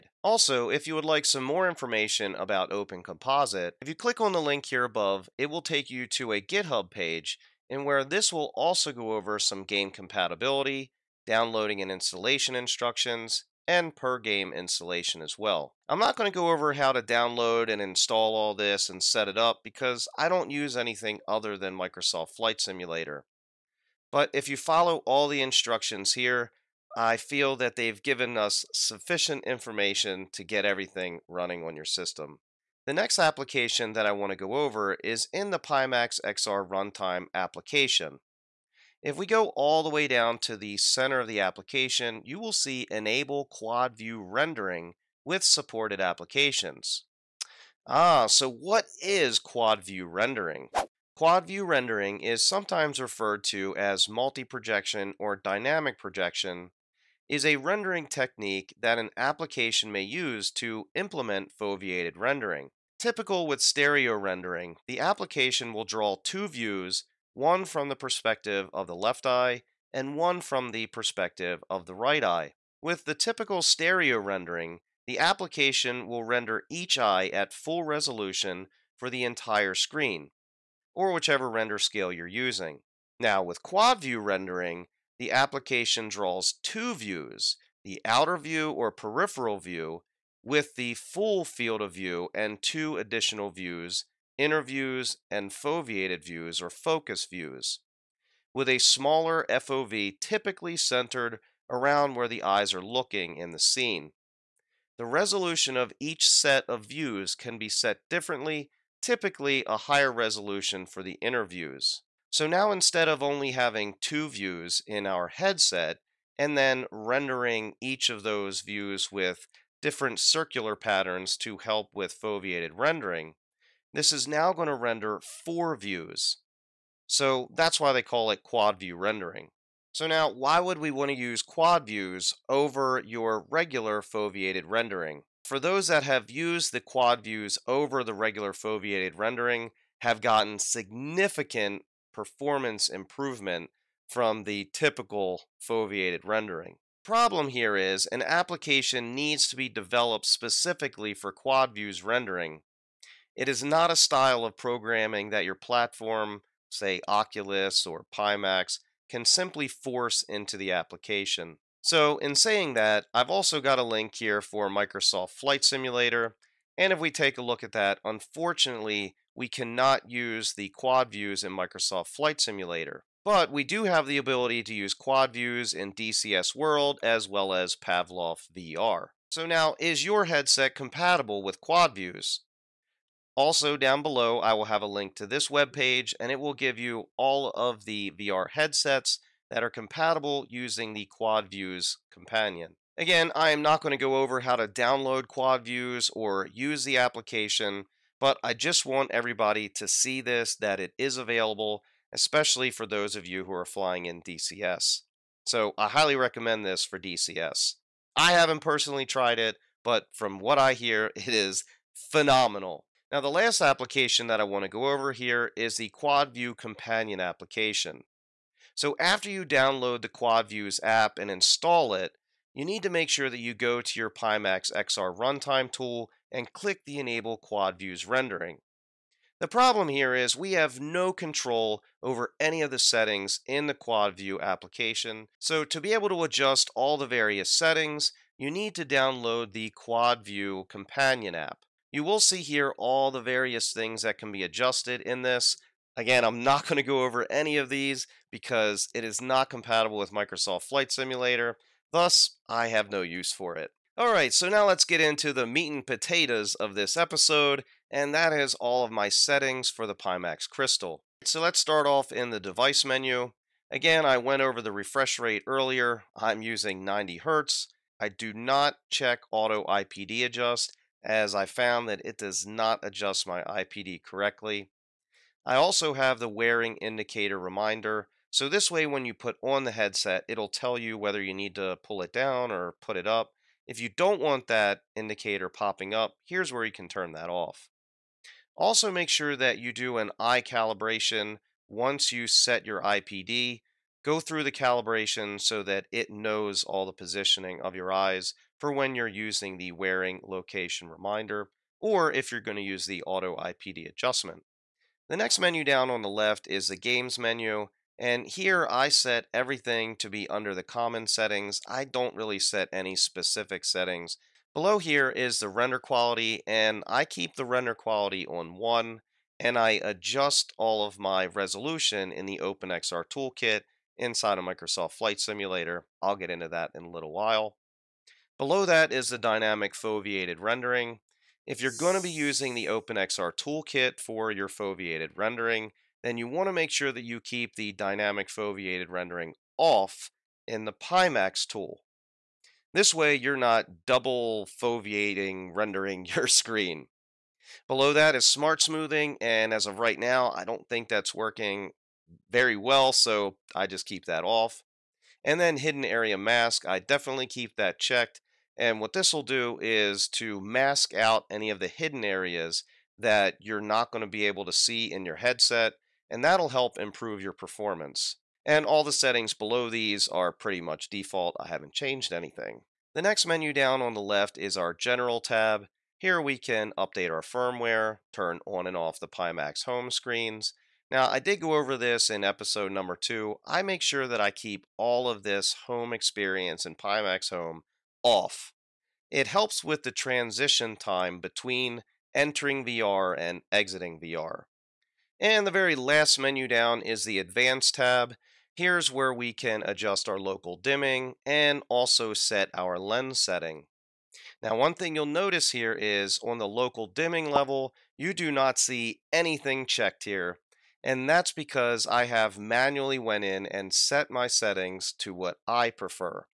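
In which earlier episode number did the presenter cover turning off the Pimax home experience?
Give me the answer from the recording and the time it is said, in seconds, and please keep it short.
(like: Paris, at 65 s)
2, at 382 s.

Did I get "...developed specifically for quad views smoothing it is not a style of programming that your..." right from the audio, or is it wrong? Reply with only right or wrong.
wrong.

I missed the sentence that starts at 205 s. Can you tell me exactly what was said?
So I highly recommend this for DCS.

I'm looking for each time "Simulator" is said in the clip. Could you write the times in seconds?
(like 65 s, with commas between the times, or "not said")
22 s, 165 s, 172 s, 250 s, 325 s.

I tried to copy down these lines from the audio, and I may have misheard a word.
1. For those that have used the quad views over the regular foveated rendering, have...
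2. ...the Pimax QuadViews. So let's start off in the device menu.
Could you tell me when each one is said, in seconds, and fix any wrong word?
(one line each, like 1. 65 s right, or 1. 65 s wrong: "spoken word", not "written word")
1. 135 s right
2. 259 s wrong: "Crystal", not "QuadViews".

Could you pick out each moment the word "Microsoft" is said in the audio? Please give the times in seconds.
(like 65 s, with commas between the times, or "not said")
21 s, 164 s, 171 s, 250 s, 324 s.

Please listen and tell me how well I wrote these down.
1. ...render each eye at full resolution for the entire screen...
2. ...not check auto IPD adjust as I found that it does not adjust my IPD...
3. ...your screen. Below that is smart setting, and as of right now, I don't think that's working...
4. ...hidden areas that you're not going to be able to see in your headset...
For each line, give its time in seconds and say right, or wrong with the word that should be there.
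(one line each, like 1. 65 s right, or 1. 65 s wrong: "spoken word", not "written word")
1. 76 s right
2. 268 s right
3. 346 s wrong: "smoothing", not "setting"
4. 361 s right.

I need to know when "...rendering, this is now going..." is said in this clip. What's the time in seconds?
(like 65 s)
122 s.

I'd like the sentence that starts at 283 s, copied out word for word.
If you don't want that indicator popping up, here's where you can turn that off.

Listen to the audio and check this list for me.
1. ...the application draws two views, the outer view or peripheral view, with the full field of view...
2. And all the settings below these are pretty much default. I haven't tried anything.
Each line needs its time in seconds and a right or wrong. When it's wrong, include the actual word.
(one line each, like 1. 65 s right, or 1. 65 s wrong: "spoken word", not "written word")
1. 85 s right
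2. 368 s wrong: "changed", not "tried".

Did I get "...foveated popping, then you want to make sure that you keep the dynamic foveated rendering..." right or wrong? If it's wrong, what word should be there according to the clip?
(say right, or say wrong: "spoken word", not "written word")
wrong: "rendering", not "popping".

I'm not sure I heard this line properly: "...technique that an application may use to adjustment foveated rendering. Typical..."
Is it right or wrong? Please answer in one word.
wrong.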